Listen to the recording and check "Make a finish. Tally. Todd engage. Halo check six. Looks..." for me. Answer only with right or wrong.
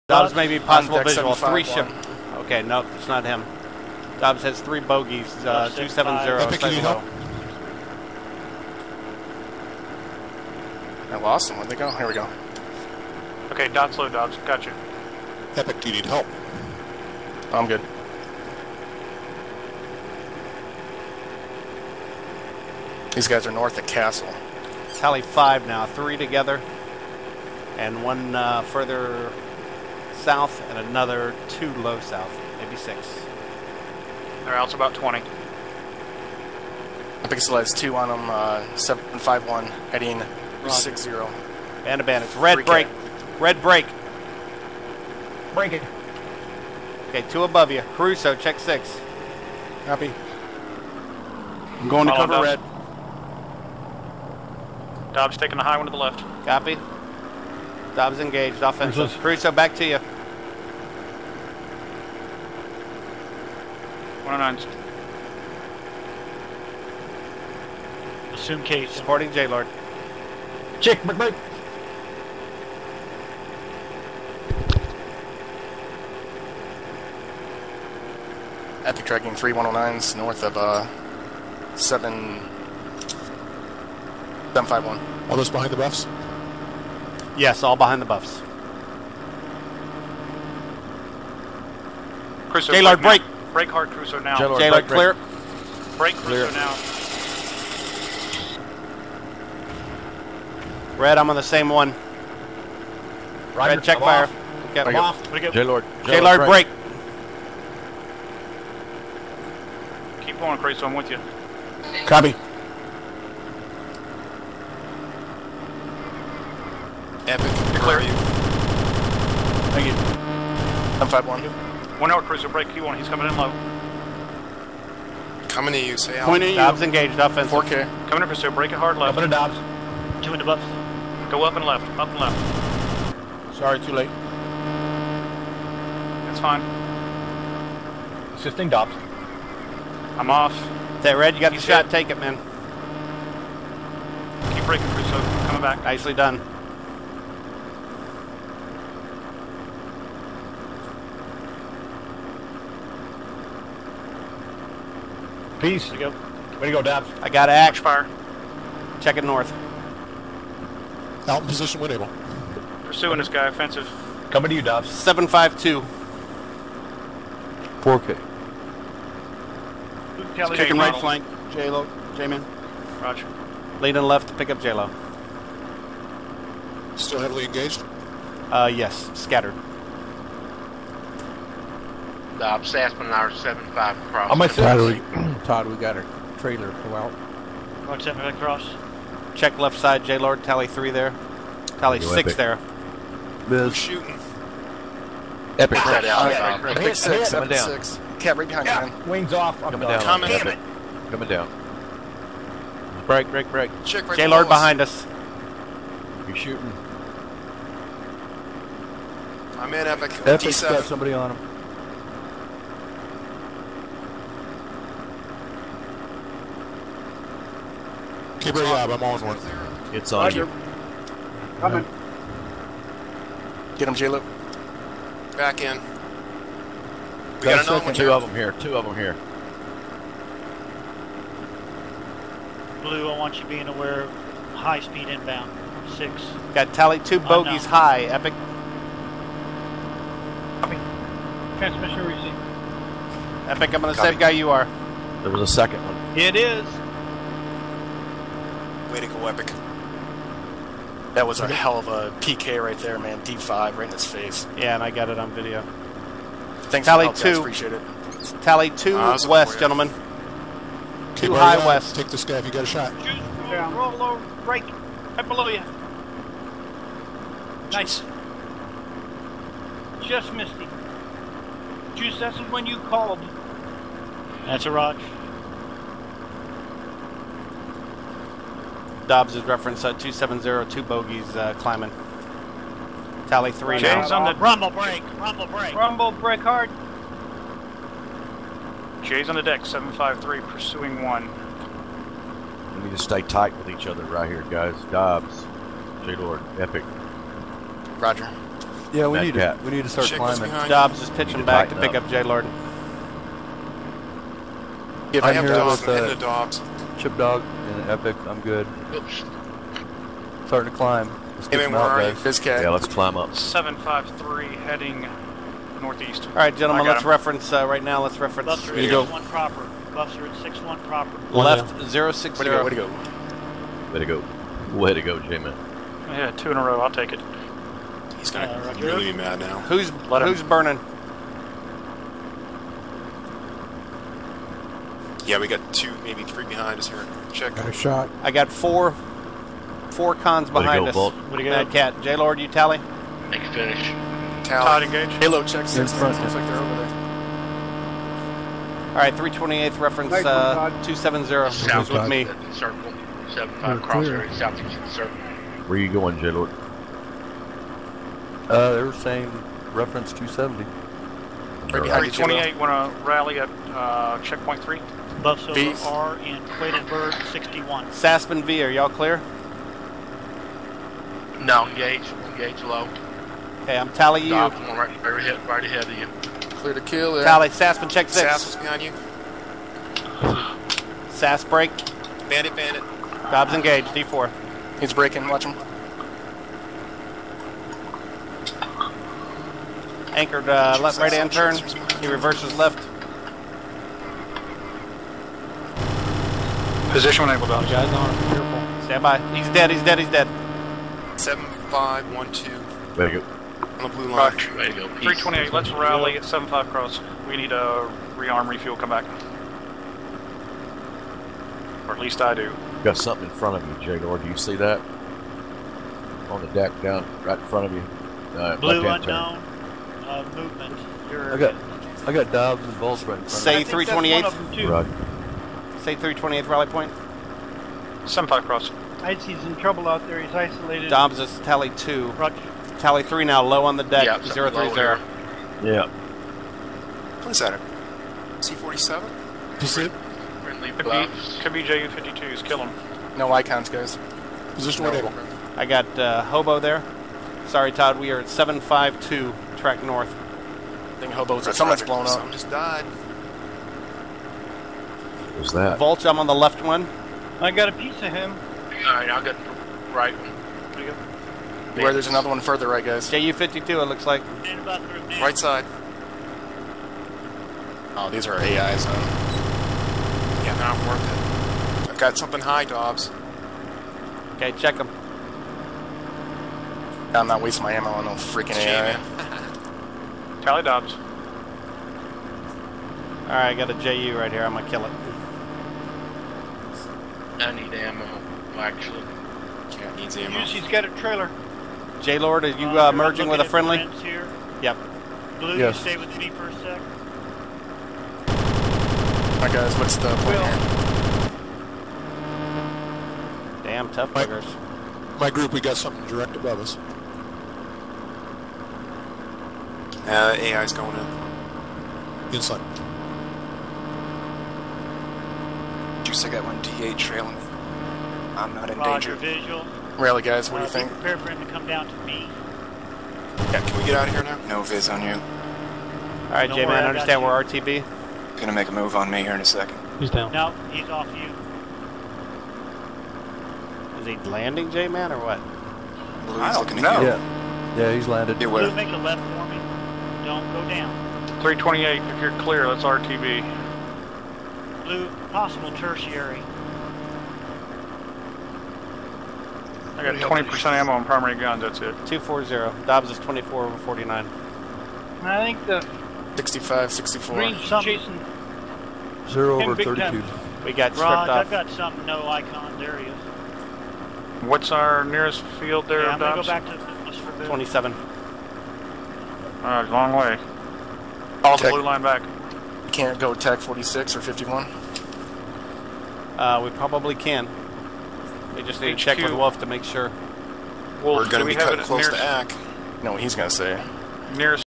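right.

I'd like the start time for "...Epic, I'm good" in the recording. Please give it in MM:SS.
05:07.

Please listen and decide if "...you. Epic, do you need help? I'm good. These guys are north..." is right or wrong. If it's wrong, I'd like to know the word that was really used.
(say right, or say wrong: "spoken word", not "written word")
right.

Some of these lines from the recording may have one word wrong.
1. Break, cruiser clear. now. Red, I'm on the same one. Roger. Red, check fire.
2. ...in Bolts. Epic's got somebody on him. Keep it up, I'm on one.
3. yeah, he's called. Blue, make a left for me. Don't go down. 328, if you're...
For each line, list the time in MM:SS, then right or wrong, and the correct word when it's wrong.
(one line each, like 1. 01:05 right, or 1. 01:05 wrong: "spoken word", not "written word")
1. 01:35 right
2. 03:29 wrong: "Epic", not "Bolts"
3. 08:57 wrong: "landed", not "called".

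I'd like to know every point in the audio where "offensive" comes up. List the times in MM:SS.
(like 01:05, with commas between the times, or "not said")
00:58, 02:07, 02:43.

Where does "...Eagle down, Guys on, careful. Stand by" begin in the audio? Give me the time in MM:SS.
06:37.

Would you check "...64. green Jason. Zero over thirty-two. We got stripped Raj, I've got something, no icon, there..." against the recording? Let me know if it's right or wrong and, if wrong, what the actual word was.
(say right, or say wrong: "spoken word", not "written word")
right.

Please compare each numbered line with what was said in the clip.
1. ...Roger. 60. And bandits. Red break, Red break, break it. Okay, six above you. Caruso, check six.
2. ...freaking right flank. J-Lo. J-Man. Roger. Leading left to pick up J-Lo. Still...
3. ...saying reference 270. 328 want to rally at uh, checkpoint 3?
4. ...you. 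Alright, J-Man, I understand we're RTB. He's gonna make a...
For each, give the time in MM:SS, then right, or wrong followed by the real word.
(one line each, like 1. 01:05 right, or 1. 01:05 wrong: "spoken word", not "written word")
1. 00:40 wrong: "two", not "six"
2. 02:50 wrong: "kicking", not "freaking"
3. 05:58 right
4. 08:45 right.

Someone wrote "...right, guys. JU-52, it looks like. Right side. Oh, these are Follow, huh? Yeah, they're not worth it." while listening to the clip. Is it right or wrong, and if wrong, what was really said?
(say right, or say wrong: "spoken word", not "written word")
wrong: "AIs", not "Follow".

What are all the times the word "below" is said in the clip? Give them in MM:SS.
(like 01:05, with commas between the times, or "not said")
04:25.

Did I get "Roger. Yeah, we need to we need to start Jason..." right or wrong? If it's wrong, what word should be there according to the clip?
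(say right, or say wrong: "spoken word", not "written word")
wrong: "Chick", not "Jason".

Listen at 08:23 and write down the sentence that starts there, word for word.
Damn tough my, My group, we got something direct above us.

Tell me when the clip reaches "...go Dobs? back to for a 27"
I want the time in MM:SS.
09:26.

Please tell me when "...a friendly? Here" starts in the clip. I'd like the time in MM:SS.
08:13.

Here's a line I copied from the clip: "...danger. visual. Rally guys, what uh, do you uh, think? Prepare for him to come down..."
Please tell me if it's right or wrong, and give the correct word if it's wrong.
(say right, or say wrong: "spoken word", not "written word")
right.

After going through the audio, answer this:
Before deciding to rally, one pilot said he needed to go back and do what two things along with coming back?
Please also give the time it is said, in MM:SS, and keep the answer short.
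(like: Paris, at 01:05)
rearm, refuel, at 06:48.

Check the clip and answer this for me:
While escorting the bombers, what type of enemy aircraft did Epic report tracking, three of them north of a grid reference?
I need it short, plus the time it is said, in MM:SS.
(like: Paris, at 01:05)
109s, at 01:19.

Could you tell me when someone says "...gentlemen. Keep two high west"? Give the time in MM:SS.
04:19.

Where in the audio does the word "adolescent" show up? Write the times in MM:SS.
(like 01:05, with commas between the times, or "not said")
not said.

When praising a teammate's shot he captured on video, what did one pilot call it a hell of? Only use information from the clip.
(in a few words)
PK.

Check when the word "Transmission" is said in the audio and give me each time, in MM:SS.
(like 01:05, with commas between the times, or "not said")
04:01.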